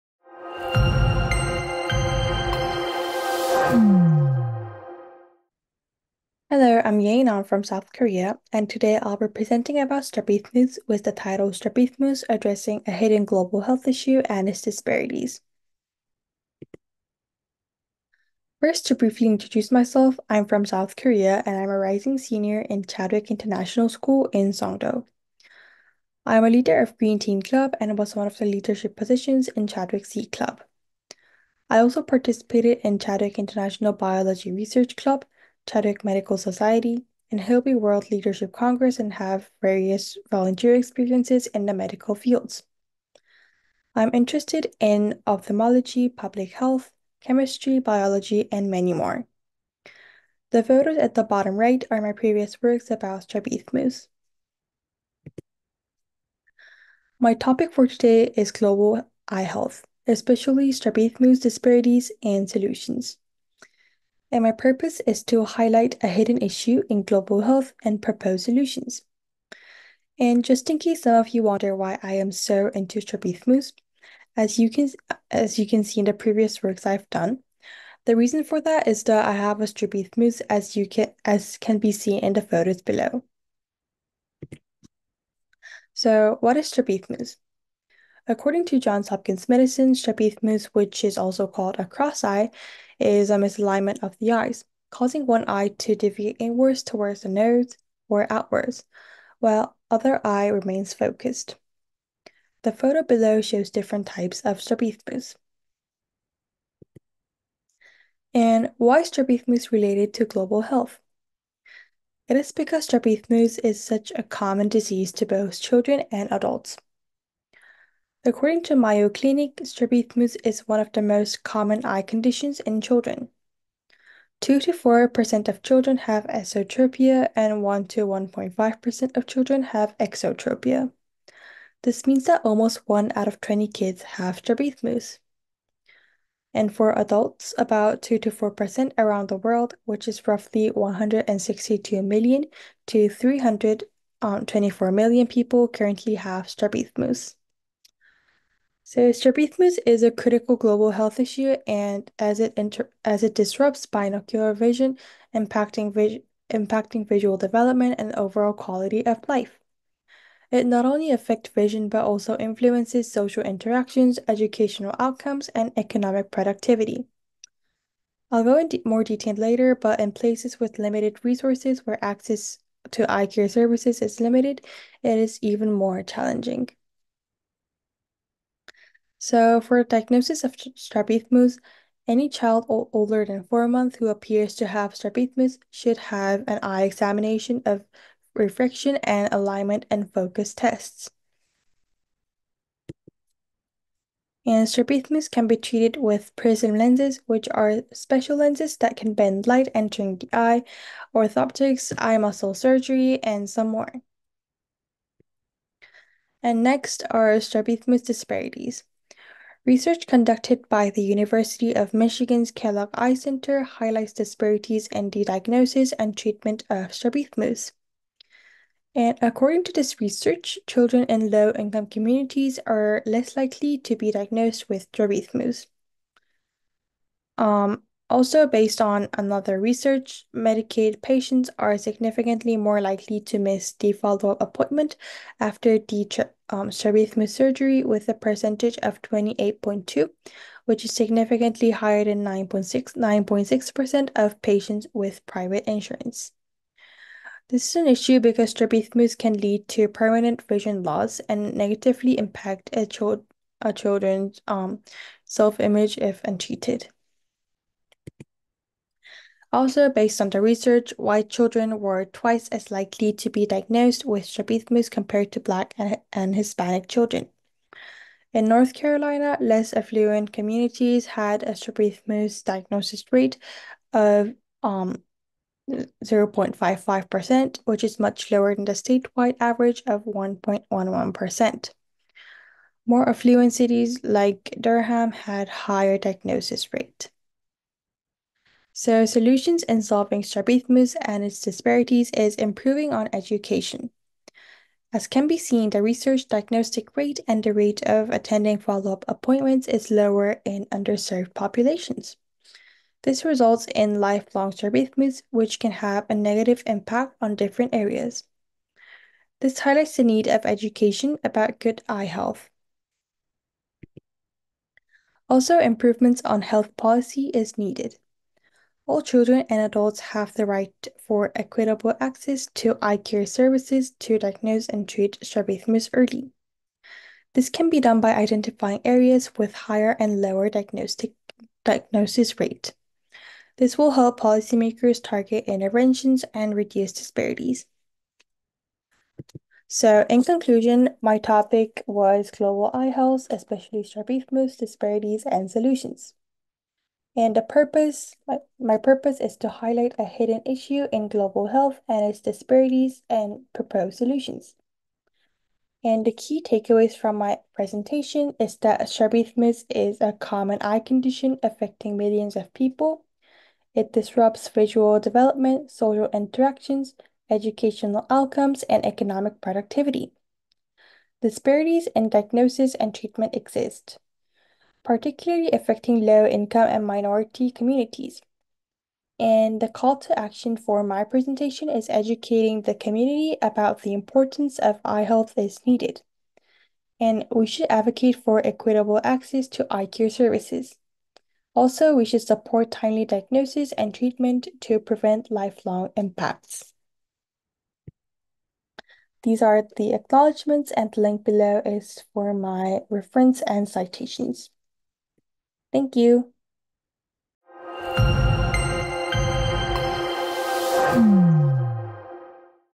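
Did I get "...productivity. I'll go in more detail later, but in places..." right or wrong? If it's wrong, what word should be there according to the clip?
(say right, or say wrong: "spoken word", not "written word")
right.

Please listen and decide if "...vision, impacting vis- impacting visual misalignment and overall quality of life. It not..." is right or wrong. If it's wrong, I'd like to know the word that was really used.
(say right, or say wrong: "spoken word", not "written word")
wrong: "development", not "misalignment".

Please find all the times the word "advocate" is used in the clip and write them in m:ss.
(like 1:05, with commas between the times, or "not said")
6:27.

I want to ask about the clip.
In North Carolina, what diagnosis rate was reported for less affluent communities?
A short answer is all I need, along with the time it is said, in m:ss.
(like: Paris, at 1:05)
0.55%, at 4:35.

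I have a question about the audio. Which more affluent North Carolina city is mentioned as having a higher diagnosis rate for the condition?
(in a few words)
Durham.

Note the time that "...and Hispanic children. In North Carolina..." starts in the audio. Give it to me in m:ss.
4:26.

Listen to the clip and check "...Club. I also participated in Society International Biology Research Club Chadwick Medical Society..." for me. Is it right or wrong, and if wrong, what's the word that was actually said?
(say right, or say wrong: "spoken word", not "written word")
wrong: "Chadwick", not "Society".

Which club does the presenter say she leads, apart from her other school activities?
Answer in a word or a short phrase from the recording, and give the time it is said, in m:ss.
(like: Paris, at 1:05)
Green Team Club, at 0:26.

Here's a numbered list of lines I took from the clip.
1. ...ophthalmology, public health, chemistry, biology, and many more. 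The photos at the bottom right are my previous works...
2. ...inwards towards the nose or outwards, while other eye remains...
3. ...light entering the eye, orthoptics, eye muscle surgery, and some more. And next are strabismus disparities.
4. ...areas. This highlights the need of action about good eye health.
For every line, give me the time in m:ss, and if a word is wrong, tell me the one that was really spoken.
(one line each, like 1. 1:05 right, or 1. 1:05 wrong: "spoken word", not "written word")
1. 0:45 right
2. 1:36 right
3. 3:19 right
4. 5:07 wrong: "education", not "action".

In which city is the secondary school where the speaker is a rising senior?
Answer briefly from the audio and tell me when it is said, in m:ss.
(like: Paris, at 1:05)
Songdo, at 0:24.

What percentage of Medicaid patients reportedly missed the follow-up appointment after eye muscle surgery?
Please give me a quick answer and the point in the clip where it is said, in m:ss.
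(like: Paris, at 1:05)
28.2%, at 3:59.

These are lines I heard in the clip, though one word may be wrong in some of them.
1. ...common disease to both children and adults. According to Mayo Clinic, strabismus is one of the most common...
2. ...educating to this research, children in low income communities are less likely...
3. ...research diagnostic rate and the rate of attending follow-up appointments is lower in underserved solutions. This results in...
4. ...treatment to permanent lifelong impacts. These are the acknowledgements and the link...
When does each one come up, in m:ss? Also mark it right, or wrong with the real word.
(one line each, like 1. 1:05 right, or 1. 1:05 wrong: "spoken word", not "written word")
1. 1:54 right
2. 3:39 wrong: "according", not "educating"
3. 4:55 wrong: "populations", not "solutions"
4. 6:33 wrong: "prevent", not "permanent".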